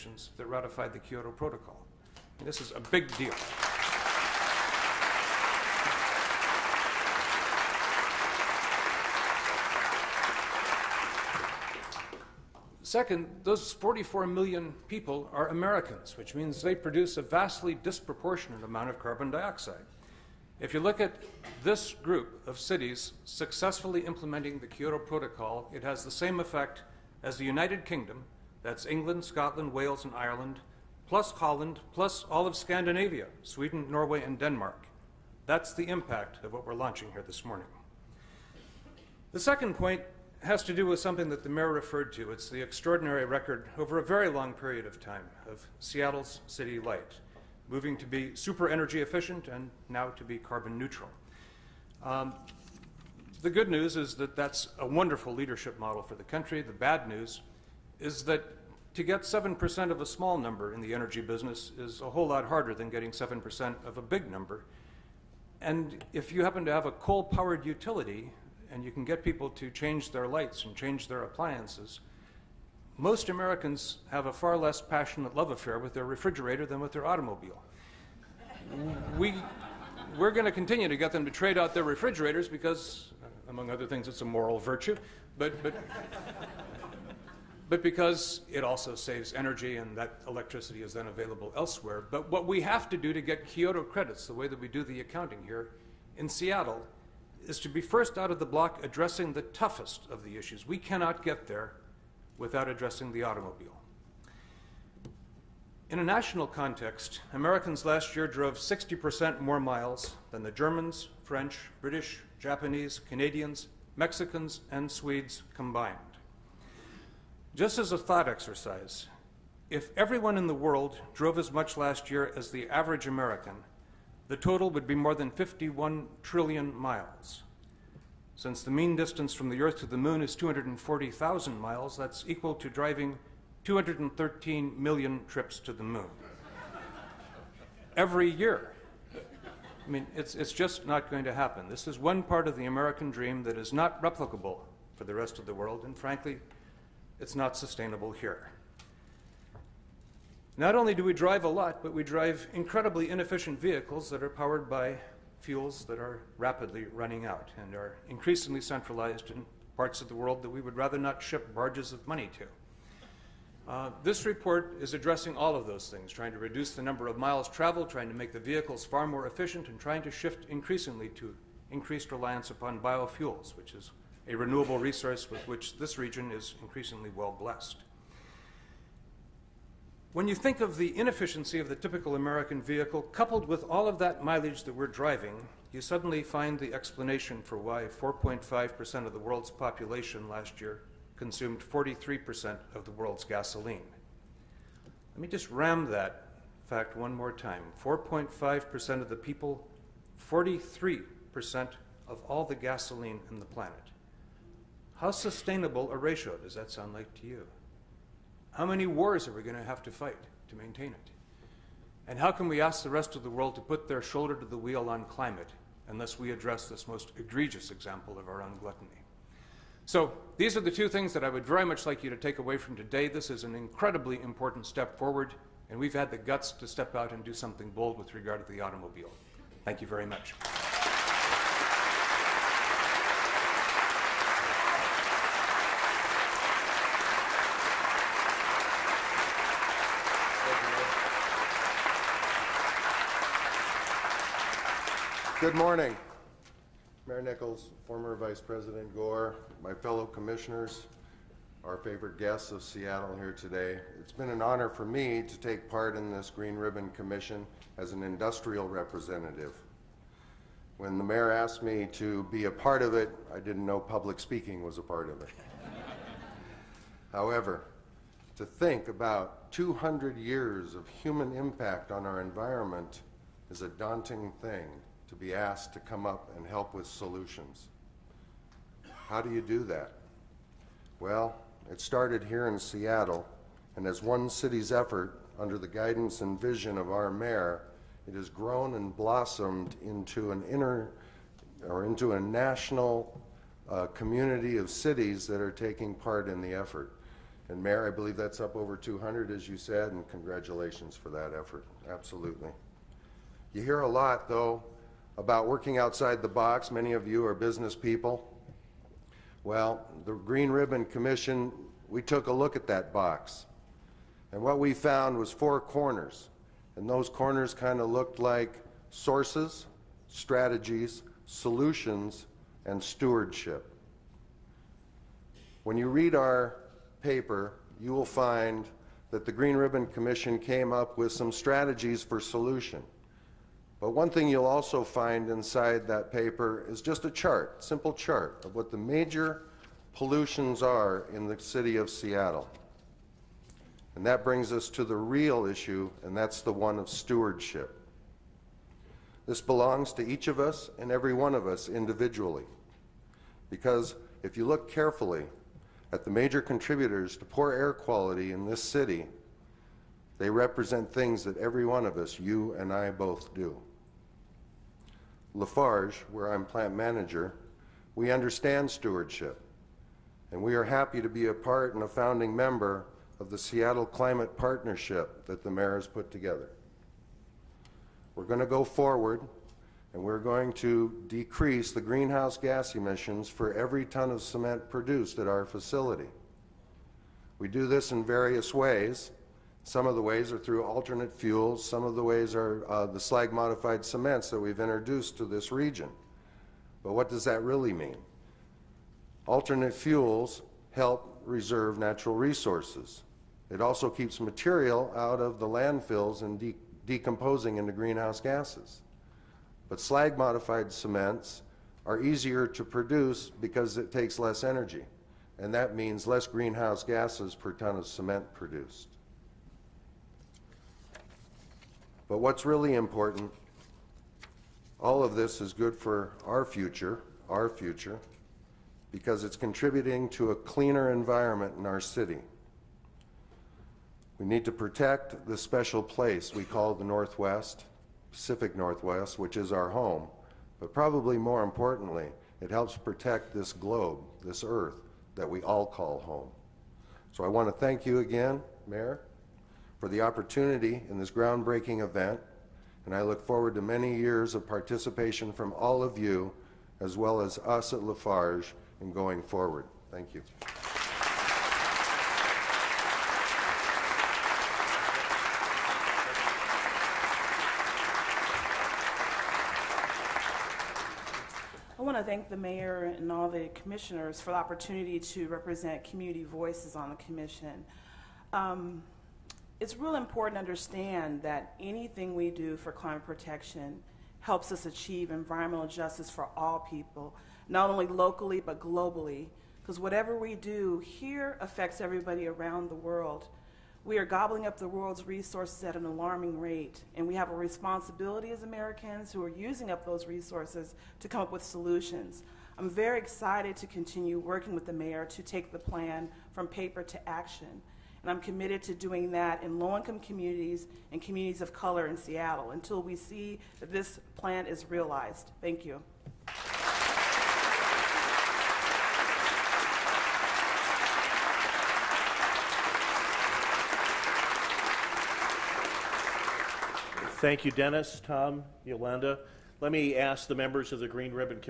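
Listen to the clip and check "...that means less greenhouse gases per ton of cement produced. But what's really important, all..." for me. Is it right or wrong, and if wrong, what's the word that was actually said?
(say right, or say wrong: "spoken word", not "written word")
right.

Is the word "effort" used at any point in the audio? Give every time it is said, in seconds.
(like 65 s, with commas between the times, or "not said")
284 s, 296 s, 301 s.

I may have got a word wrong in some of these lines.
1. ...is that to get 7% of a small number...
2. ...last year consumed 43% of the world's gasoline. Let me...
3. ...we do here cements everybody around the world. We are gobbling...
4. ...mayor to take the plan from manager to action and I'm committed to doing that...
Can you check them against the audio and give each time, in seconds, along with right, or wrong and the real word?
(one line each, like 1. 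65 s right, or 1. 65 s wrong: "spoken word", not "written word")
1. 57 s right
2. 190 s right
3. 490 s wrong: "affects", not "cements"
4. 504 s wrong: "paper", not "manager".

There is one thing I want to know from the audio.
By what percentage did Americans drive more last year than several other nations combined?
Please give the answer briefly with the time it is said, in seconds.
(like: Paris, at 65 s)
60%, at 108 s.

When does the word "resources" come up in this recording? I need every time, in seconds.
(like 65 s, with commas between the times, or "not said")
174 s, 402 s, 495 s, 500 s.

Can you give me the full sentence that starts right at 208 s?
How many wars are we going to have to fight to maintain it?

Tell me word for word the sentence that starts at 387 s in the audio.
We do this in various ways, some of the ways are through alternate fuels.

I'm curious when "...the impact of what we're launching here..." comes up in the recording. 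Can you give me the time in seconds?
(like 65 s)
35 s.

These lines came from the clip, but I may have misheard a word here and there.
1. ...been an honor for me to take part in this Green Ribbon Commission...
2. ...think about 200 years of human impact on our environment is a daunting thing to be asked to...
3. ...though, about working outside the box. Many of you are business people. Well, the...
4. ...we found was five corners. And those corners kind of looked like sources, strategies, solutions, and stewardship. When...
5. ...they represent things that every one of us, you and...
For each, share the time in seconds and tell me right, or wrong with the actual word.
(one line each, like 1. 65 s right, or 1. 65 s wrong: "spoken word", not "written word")
1. 254 s right
2. 268 s right
3. 304 s right
4. 314 s wrong: "four", not "five"
5. 360 s right.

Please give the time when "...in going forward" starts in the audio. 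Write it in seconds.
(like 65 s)
458 s.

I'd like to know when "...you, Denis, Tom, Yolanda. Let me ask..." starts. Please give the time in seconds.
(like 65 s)
527 s.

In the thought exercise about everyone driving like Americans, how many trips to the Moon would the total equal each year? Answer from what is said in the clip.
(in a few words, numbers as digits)
213 million.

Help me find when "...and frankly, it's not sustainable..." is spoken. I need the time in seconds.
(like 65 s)
145 s.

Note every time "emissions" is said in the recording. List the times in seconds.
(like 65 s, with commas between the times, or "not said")
382 s.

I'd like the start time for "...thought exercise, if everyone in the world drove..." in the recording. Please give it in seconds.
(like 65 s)
117 s.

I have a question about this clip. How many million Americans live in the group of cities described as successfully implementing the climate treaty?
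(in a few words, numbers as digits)
44 million.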